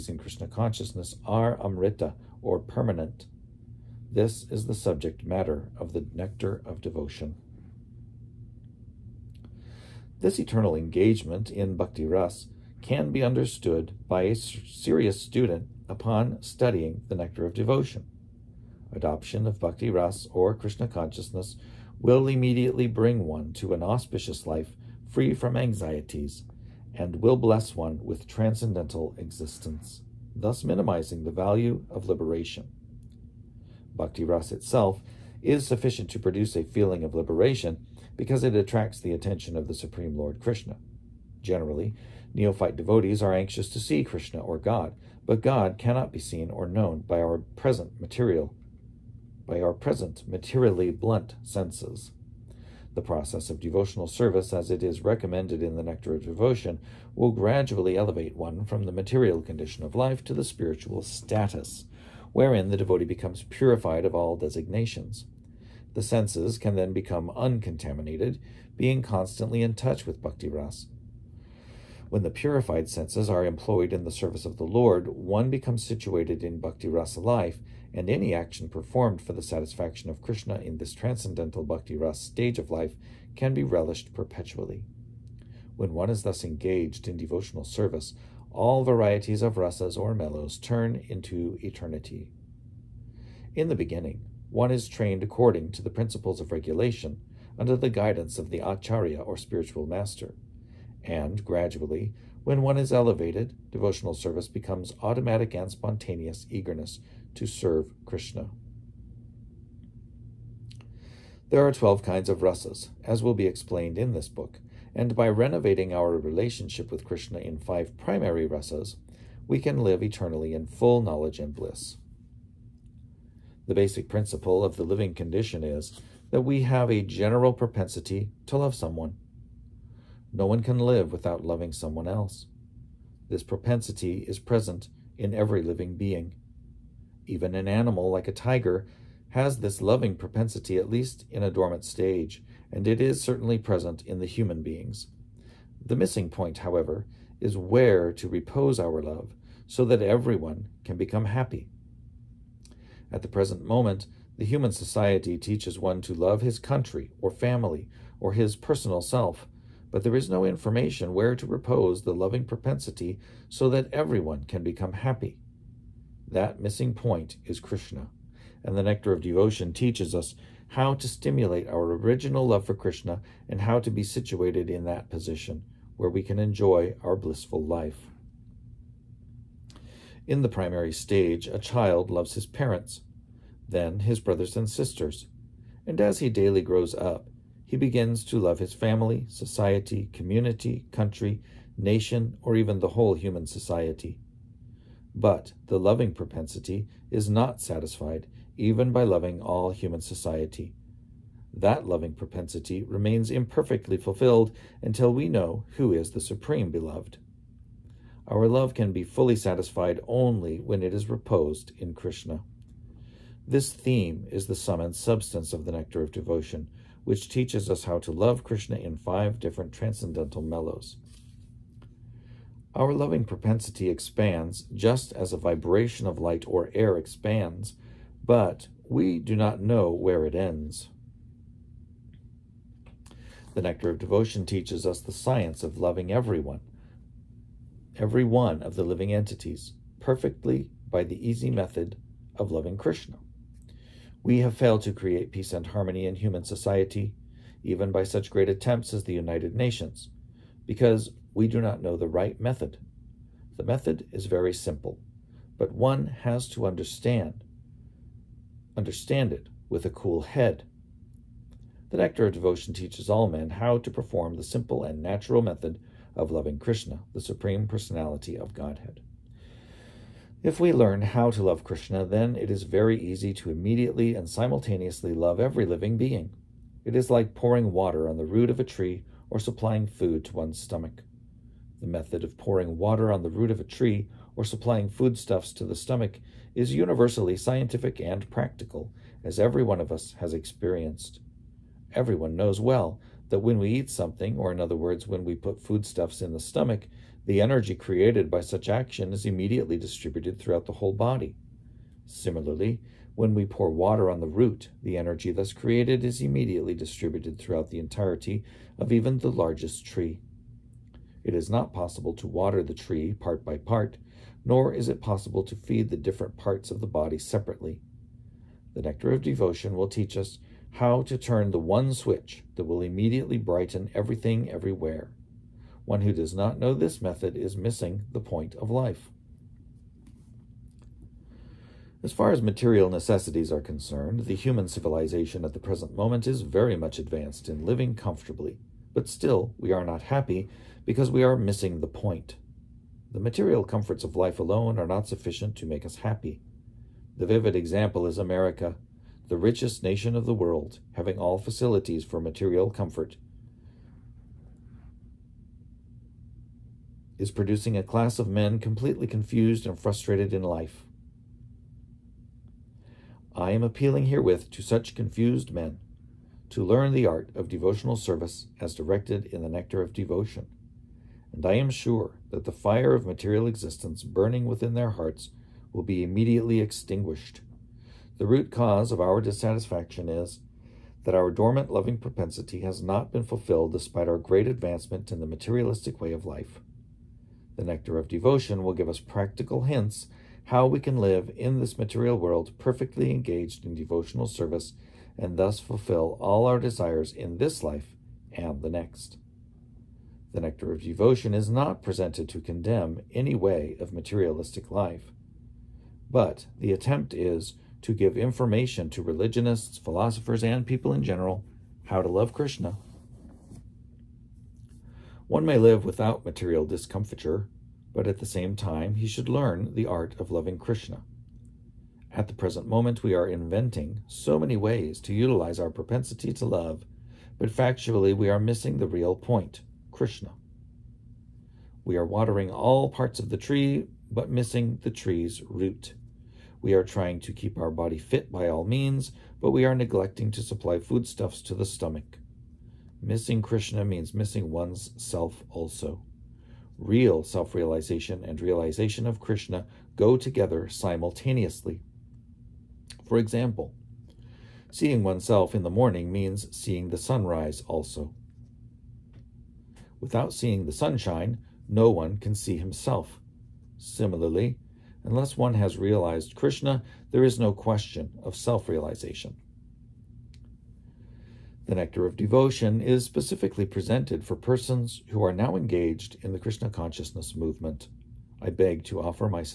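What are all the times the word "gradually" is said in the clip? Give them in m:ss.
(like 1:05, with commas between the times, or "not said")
0:57, 1:41.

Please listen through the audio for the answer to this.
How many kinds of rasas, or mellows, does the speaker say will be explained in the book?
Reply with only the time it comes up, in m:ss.
1:51.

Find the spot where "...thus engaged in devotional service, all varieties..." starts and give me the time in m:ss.
1:26.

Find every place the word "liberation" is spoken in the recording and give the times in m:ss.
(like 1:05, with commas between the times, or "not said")
0:32, 0:37.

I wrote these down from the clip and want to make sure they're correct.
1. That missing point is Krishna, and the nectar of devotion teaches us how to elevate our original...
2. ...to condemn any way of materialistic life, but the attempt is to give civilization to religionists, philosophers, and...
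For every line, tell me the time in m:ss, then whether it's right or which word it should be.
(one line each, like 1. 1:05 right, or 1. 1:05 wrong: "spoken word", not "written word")
1. 2:46 wrong: "stimulate", not "elevate"
2. 6:42 wrong: "information", not "civilization".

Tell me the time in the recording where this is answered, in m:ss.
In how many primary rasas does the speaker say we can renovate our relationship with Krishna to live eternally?
1:57.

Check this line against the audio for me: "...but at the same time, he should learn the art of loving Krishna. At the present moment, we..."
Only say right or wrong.
right.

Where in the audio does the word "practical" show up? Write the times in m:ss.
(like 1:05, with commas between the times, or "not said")
4:48, 6:29.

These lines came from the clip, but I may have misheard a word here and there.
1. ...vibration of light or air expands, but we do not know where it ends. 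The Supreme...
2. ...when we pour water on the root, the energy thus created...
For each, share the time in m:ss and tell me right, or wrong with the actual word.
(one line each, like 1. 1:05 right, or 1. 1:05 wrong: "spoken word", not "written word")
1. 3:45 wrong: "Nectar", not "Supreme"
2. 5:03 right.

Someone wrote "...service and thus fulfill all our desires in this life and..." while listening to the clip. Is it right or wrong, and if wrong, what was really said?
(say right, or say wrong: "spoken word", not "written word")
right.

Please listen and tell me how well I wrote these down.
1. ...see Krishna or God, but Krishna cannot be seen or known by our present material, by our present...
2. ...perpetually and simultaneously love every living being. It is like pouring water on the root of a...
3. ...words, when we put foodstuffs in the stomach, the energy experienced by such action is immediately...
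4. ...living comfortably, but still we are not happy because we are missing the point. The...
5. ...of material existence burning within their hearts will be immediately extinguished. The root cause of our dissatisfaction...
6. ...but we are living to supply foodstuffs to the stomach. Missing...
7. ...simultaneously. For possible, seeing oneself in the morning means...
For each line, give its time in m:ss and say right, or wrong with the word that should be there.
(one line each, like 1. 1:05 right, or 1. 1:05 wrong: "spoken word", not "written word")
1. 0:43 wrong: "God", not "Krishna"
2. 4:33 wrong: "immediately", not "perpetually"
3. 4:54 wrong: "created", not "experienced"
4. 5:37 right
5. 6:12 right
6. 7:19 wrong: "neglecting", not "living"
7. 7:30 wrong: "example", not "possible".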